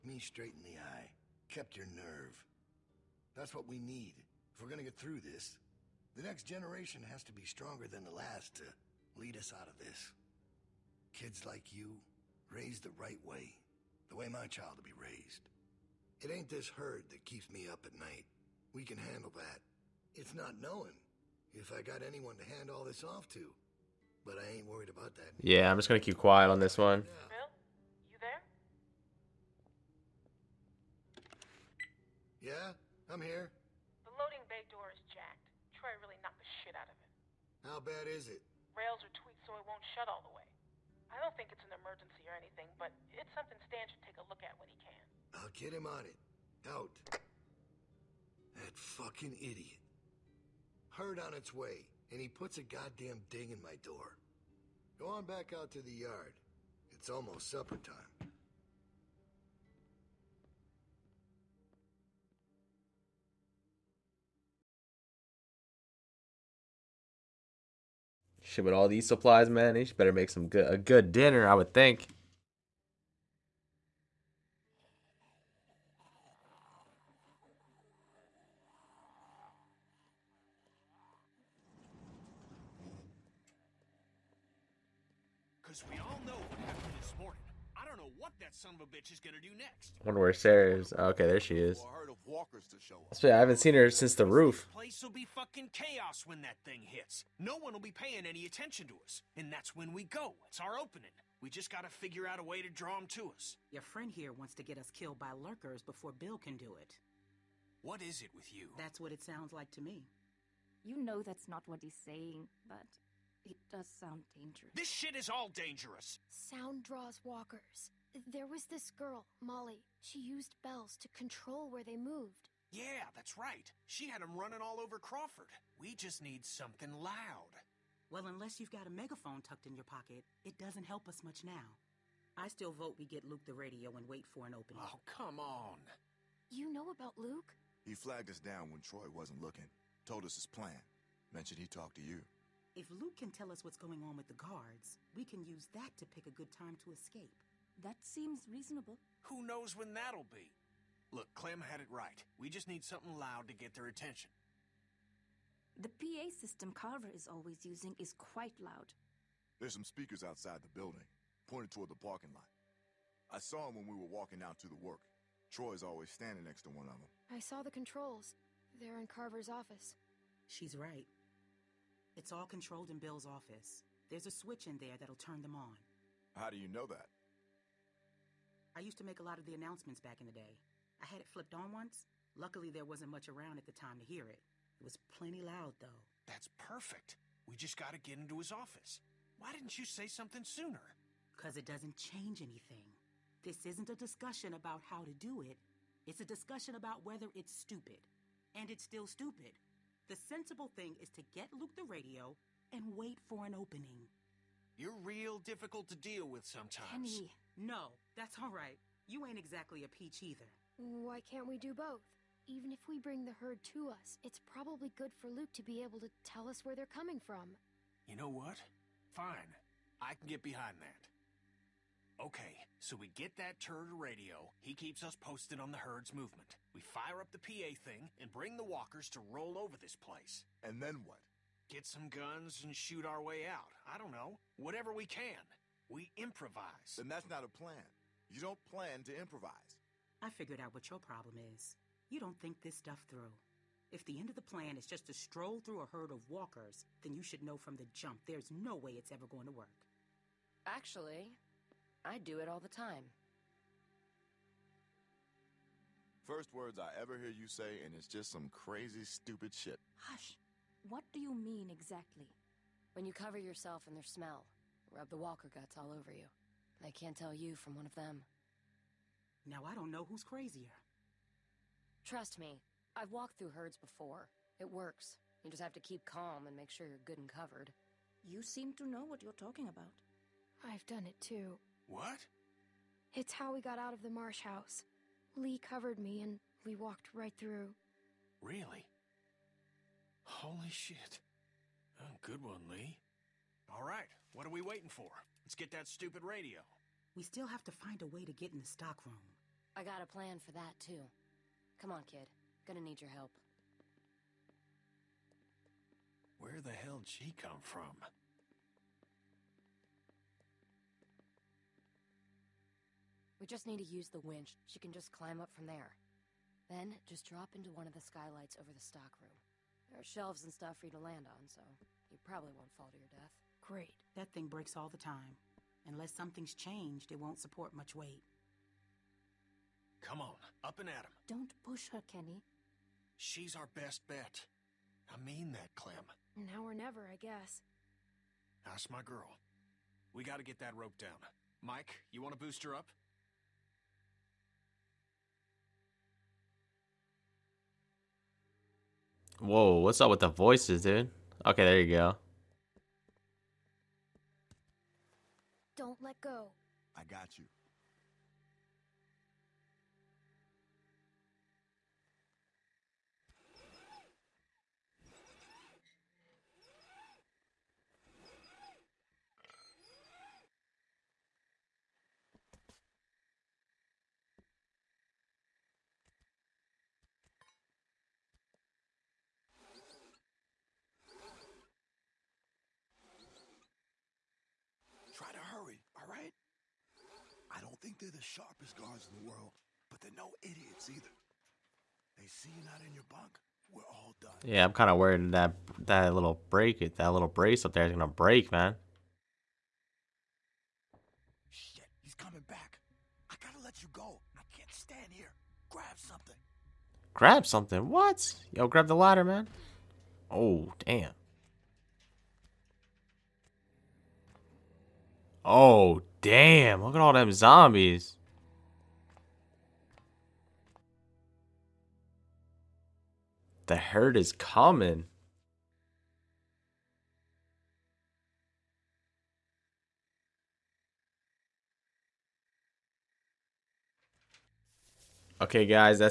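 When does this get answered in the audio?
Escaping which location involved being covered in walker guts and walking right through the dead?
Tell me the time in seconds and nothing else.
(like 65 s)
284 s.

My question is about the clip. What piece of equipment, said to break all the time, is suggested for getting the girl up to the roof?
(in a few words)
The winch.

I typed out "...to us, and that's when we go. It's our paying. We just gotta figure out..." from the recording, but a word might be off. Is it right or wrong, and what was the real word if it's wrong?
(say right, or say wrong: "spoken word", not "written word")
wrong: "opening", not "paying".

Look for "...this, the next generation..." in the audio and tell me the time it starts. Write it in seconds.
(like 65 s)
5 s.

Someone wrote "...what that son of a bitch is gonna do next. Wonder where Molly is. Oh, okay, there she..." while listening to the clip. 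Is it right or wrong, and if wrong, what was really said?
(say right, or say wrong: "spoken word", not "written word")
wrong: "Sarah", not "Molly".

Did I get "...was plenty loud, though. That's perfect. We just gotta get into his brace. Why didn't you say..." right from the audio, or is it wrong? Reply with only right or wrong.
wrong.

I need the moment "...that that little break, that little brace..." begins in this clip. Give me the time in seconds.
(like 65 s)
395 s.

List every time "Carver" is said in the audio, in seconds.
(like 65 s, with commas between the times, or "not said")
156 s, 169 s.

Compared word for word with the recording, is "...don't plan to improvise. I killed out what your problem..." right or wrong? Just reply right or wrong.
wrong.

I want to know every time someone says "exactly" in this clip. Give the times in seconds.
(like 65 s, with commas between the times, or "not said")
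209 s, 261 s.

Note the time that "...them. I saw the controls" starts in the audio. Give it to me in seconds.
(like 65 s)
167 s.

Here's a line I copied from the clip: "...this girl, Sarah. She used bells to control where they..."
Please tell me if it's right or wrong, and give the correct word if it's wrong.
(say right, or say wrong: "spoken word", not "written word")
wrong: "Molly", not "Sarah".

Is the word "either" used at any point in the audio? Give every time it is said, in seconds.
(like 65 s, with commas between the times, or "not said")
210 s, 390 s.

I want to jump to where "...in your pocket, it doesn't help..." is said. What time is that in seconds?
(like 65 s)
129 s.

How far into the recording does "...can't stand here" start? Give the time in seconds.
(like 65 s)
404 s.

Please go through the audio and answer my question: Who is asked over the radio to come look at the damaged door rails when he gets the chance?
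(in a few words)
Stan.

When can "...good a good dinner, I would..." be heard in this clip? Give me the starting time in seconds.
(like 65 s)
70 s.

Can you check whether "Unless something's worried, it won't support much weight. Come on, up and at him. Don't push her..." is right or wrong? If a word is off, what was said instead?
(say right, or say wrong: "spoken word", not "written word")
wrong: "changed", not "worried".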